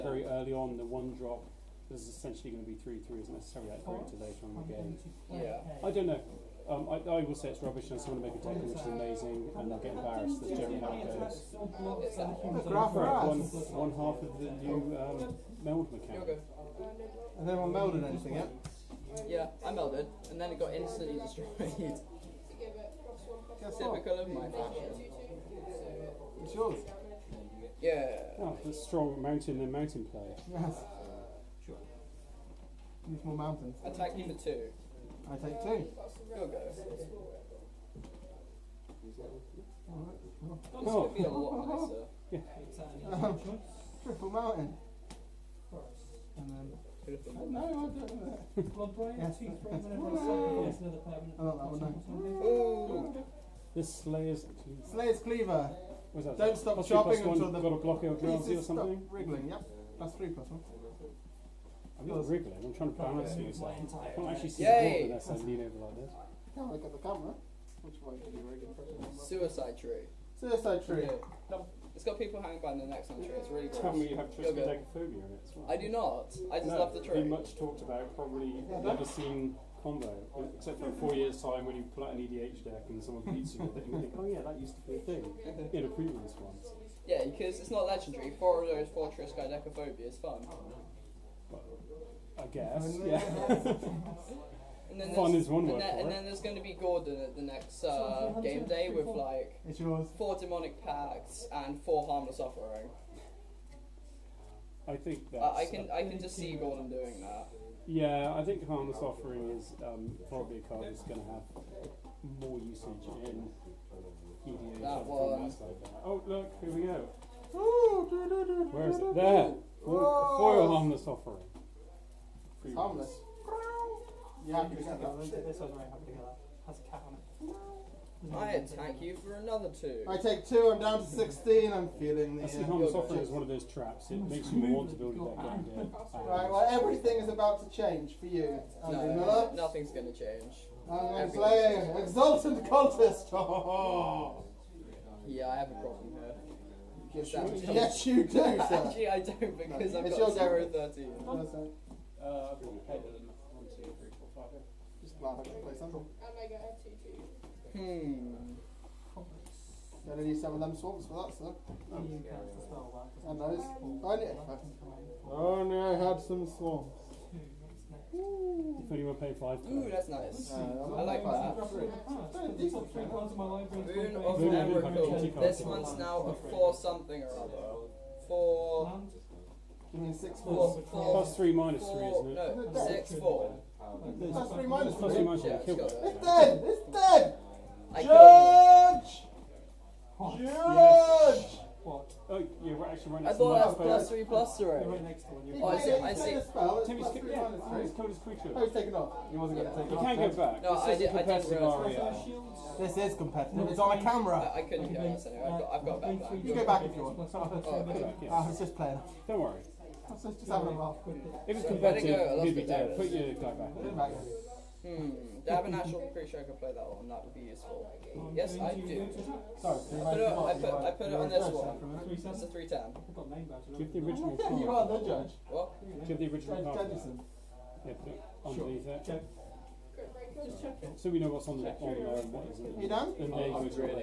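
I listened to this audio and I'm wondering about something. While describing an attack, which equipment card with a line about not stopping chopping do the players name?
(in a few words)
Slayer's Cleaver.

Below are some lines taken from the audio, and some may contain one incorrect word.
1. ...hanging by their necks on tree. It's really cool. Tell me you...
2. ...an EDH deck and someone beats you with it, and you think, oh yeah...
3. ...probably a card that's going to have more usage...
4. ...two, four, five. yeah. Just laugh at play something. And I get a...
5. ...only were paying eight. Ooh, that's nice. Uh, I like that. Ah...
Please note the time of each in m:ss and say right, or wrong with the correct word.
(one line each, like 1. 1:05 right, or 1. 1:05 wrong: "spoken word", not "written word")
1. 1:12 right
2. 1:22 right
3. 1:50 right
4. 2:33 wrong: "three", not "two"
5. 2:48 wrong: "five", not "eight".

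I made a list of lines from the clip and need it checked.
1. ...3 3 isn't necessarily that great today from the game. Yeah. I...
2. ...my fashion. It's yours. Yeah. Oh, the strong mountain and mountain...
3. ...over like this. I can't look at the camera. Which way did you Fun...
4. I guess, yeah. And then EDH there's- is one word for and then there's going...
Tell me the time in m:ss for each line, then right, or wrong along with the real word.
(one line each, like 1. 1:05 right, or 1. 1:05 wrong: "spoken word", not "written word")
1. 0:02 right
2. 0:24 right
3. 1:05 wrong: "Suicide", not "Fun"
4. 1:32 wrong: "Fun", not "EDH".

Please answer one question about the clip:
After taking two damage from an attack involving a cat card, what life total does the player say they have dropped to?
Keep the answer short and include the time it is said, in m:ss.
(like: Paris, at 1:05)
16, at 2:10.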